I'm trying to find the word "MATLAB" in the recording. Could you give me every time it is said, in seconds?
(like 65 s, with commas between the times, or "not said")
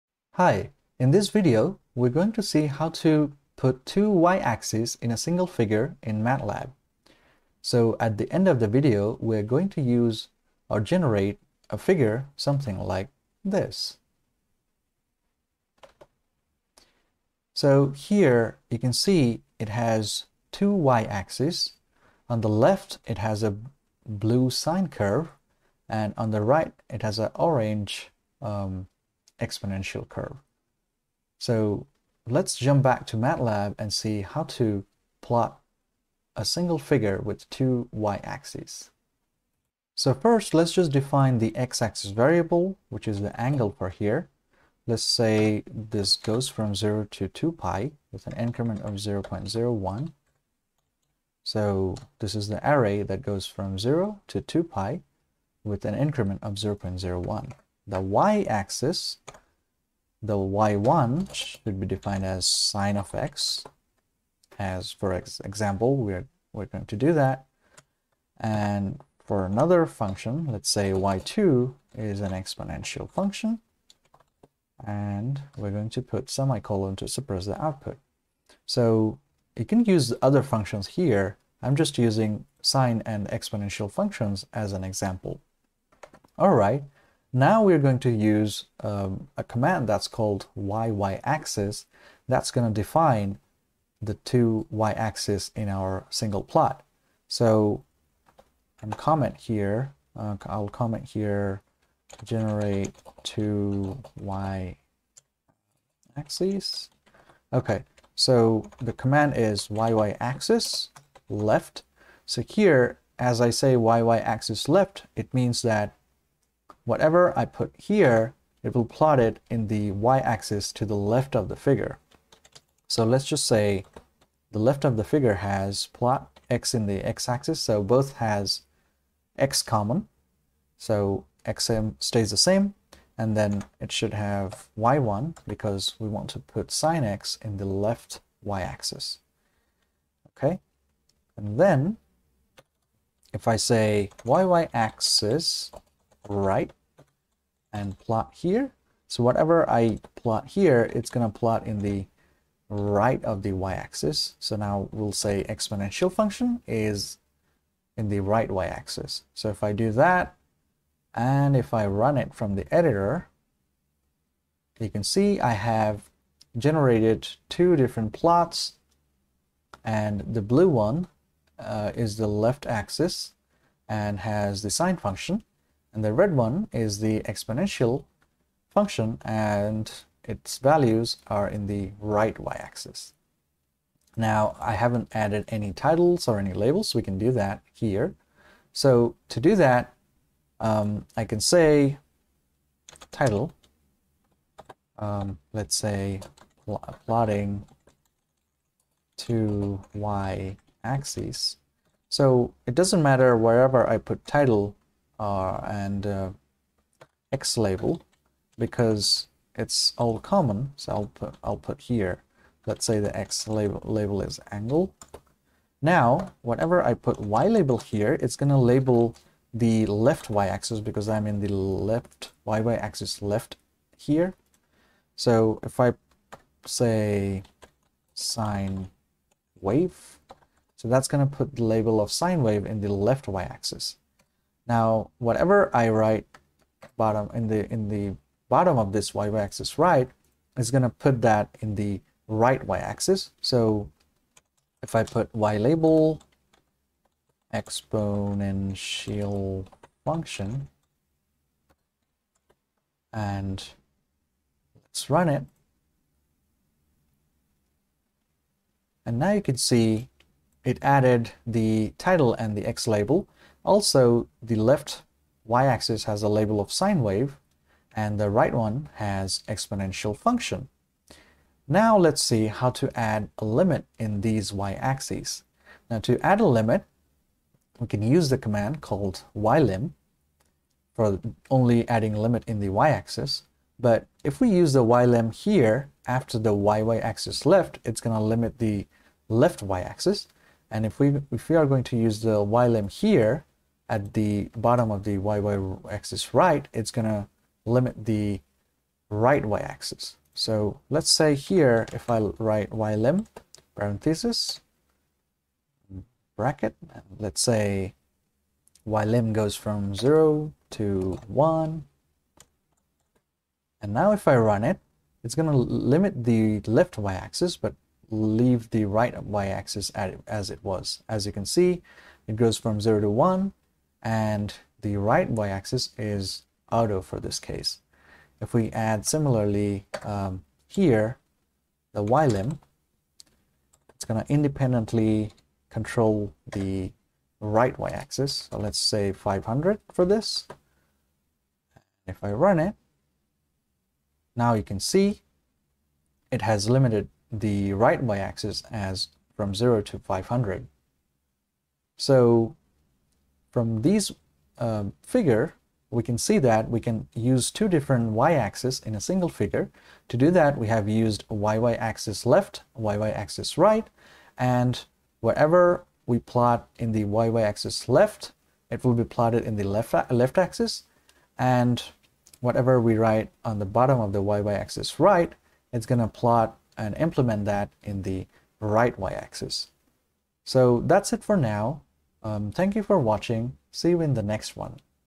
6 s, 33 s.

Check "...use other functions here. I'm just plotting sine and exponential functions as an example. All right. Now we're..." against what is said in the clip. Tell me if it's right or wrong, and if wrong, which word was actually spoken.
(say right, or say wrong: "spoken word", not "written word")
wrong: "using", not "plotting".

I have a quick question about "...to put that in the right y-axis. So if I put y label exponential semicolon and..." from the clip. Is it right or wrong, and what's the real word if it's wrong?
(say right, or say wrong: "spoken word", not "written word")
wrong: "function", not "semicolon".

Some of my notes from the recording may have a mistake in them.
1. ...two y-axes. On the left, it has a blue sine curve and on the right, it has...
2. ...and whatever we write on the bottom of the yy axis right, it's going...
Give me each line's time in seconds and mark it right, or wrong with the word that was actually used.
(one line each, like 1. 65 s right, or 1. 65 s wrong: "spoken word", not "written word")
1. 20 s right
2. 371 s right.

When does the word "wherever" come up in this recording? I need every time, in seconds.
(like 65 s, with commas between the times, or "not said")
203 s, 365 s.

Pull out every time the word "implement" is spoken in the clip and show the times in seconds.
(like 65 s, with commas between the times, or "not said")
376 s.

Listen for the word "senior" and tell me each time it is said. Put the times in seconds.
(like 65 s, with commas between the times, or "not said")
not said.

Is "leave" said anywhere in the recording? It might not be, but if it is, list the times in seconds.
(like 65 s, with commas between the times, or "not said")
318 s.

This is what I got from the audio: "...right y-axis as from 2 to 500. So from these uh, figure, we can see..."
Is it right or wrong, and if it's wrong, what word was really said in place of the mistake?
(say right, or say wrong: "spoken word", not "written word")
wrong: "0", not "2".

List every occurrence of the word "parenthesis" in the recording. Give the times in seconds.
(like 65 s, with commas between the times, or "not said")
303 s.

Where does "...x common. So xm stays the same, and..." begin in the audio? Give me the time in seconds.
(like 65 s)
129 s.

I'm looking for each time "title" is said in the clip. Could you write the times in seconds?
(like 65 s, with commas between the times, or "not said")
185 s, 193 s, 204 s, 261 s.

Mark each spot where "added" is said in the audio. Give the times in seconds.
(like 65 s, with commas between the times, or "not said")
185 s, 260 s.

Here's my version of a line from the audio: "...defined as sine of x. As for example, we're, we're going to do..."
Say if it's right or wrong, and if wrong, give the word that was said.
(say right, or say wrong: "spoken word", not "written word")
right.